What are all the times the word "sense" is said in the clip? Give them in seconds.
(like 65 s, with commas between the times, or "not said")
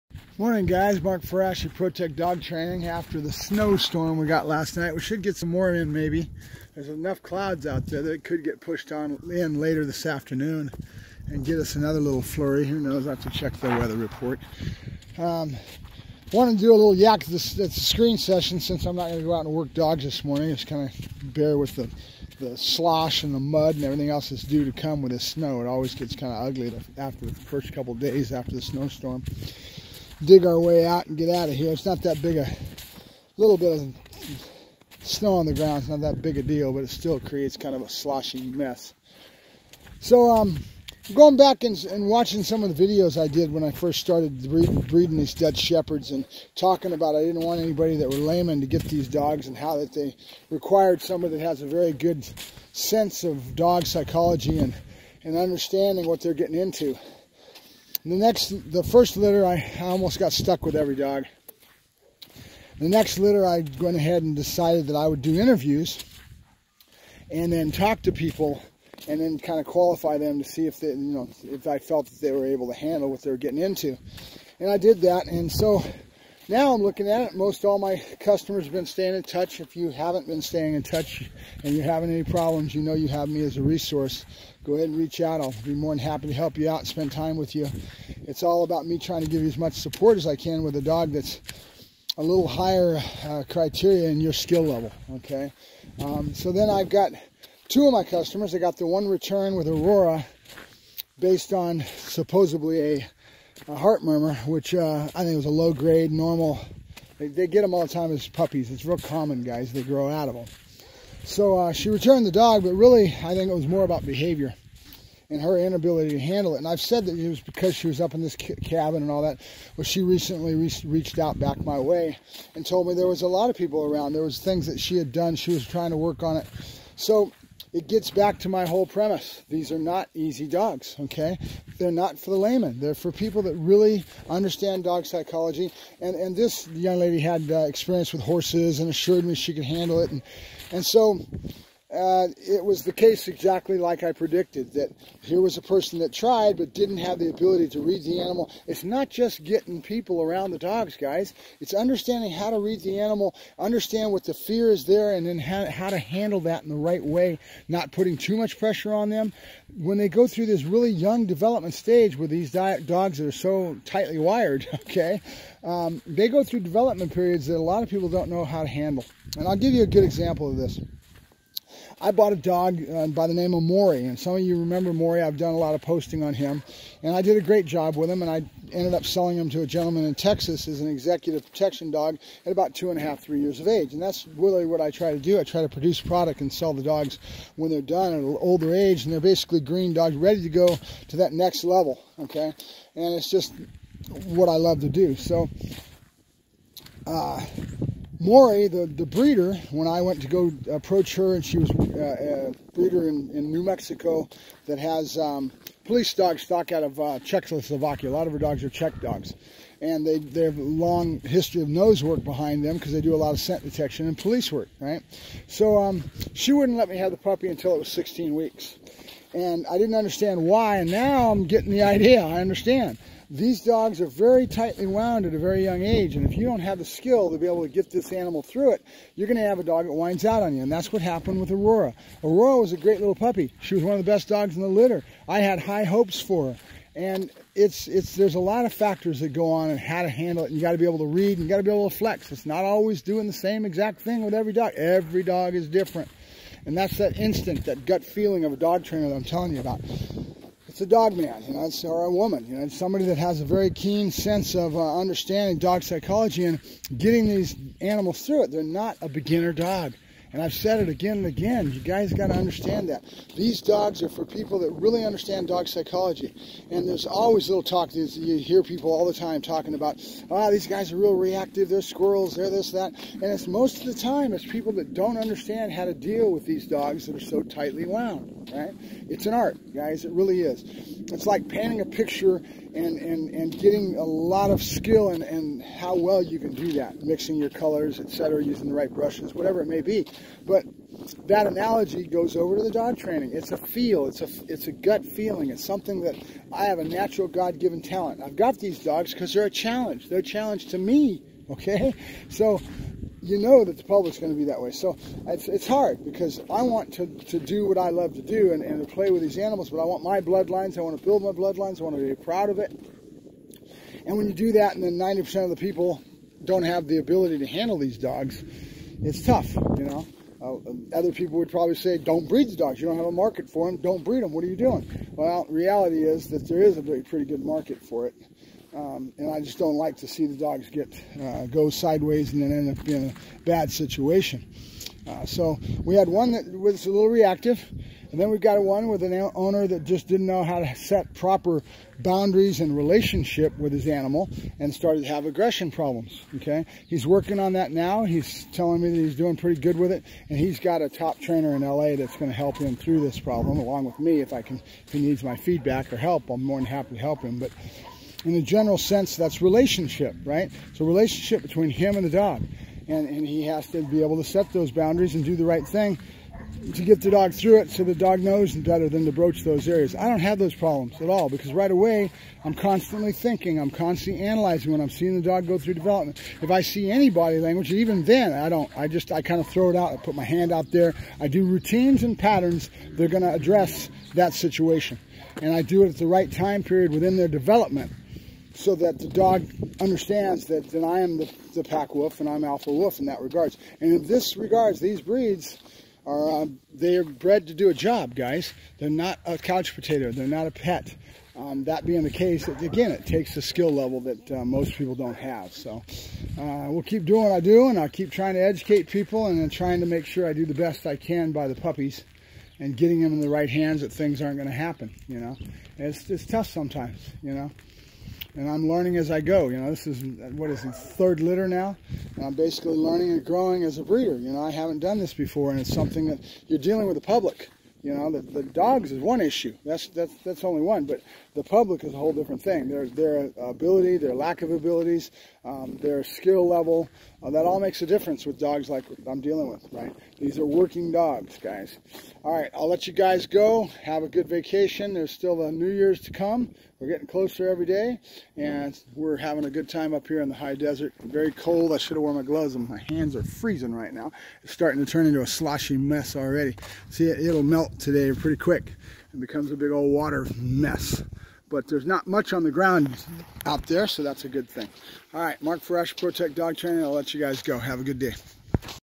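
52 s, 254 s, 358 s.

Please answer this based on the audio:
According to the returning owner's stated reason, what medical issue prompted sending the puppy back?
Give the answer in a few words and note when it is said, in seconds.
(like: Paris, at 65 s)
heart murmur, at 103 s.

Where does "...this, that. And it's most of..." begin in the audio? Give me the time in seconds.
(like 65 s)
272 s.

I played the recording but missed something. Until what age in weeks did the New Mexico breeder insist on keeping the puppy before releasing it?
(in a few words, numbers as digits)
16 weeks.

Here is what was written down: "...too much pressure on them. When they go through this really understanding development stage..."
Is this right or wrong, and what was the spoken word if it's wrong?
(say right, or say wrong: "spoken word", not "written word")
wrong: "young", not "understanding".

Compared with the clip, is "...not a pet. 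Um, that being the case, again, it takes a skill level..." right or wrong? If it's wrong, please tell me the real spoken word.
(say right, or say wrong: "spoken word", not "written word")
right.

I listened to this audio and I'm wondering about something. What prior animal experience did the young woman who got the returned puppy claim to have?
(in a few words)
horses.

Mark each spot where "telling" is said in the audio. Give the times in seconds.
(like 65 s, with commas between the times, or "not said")
249 s, 348 s.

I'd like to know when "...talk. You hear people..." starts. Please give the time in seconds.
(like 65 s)
267 s.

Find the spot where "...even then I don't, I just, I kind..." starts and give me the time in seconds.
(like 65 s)
377 s.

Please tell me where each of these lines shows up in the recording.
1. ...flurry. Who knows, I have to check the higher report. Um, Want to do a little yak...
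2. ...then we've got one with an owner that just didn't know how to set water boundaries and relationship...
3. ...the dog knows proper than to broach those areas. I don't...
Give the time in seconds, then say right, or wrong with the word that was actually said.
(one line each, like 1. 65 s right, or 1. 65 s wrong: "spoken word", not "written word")
1. 12 s wrong: "weather", not "higher"
2. 338 s wrong: "proper", not "water"
3. 367 s wrong: "better", not "proper".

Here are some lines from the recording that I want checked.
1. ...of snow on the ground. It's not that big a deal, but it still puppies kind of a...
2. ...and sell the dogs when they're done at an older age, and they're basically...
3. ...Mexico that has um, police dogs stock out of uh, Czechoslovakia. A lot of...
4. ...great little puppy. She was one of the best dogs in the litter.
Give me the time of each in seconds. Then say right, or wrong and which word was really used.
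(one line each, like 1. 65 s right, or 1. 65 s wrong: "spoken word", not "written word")
1. 33 s wrong: "creates", not "puppies"
2. 186 s right
3. 203 s right
4. 232 s right.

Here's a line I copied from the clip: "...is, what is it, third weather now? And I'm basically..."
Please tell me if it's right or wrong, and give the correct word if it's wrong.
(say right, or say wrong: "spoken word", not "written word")
wrong: "litter", not "weather".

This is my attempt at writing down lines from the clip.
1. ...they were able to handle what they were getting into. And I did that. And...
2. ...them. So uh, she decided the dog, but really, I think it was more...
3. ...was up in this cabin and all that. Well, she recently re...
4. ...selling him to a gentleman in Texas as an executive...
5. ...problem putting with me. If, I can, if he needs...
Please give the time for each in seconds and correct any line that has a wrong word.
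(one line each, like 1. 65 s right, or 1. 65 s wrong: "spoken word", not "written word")
1. 72 s right
2. 110 s wrong: "returned", not "decided"
3. 117 s right
4. 179 s right
5. 353 s wrong: "along", not "putting".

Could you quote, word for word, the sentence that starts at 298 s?
I've got these dogs because they're a challenge.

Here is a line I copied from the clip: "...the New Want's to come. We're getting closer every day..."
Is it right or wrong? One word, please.
wrong.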